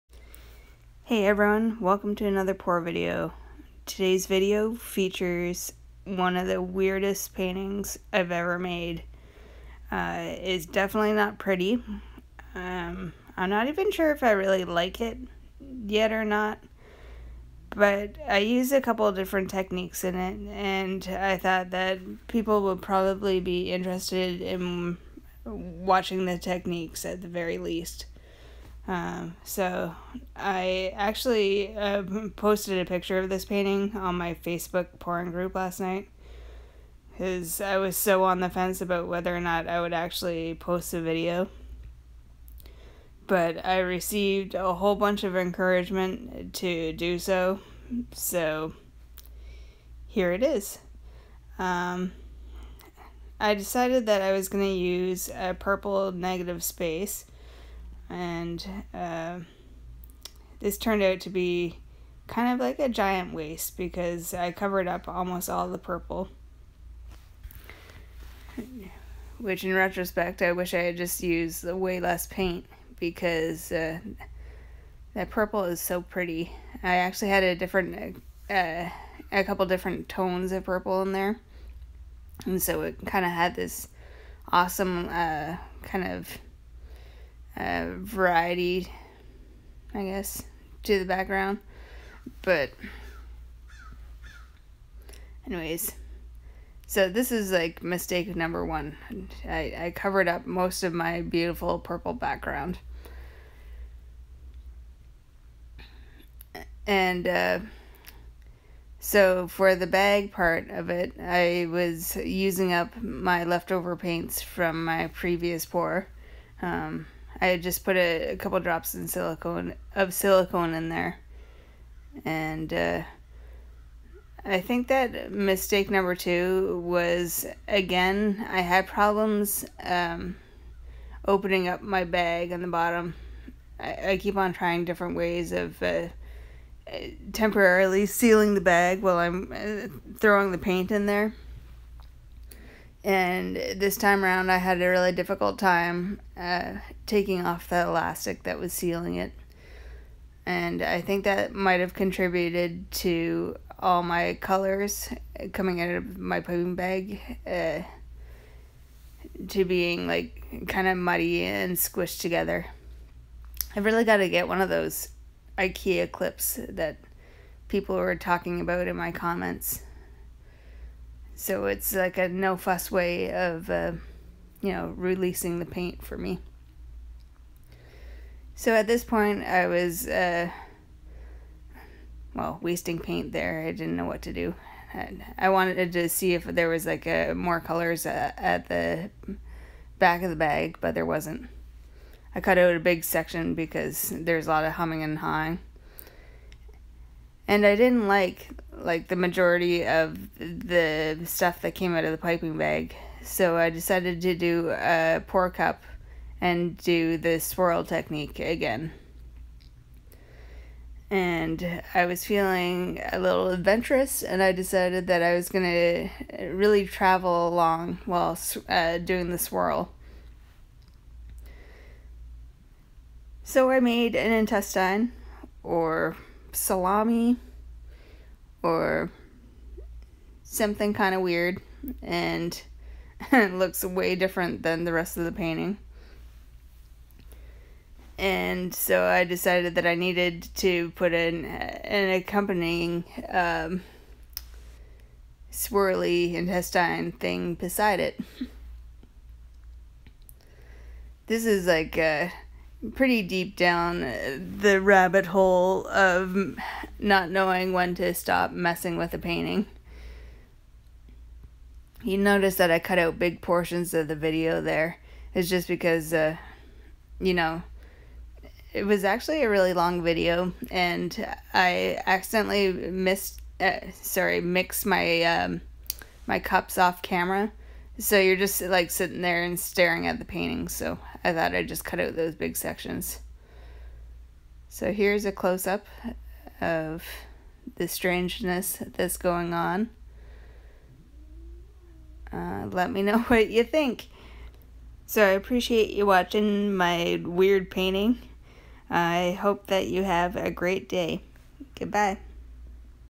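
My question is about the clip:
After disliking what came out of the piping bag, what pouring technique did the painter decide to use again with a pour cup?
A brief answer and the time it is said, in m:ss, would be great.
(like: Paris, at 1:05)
Swirl technique, at 3:27.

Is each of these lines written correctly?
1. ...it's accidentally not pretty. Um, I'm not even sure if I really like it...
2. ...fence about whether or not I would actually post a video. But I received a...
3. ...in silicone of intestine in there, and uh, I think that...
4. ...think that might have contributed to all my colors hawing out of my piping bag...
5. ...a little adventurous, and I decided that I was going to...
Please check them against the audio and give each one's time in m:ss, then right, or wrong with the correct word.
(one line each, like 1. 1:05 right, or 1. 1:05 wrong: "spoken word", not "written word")
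1. 0:10 wrong: "definitely", not "accidentally"
2. 0:38 right
3. 1:58 wrong: "silicone", not "intestine"
4. 2:31 wrong: "coming", not "hawing"
5. 3:33 right.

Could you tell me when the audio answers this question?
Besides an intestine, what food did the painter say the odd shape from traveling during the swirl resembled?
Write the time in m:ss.
3:46.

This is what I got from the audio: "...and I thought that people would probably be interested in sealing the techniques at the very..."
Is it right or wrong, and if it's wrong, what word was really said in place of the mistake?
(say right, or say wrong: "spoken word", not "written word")
wrong: "watching", not "sealing".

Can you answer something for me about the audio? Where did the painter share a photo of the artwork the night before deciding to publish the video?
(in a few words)
Facebook pouring group.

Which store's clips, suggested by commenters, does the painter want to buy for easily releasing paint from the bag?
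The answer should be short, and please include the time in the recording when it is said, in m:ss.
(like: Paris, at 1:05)
IKEA, at 2:45.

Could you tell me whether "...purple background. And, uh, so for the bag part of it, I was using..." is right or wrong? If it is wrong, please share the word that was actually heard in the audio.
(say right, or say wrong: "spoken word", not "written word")
right.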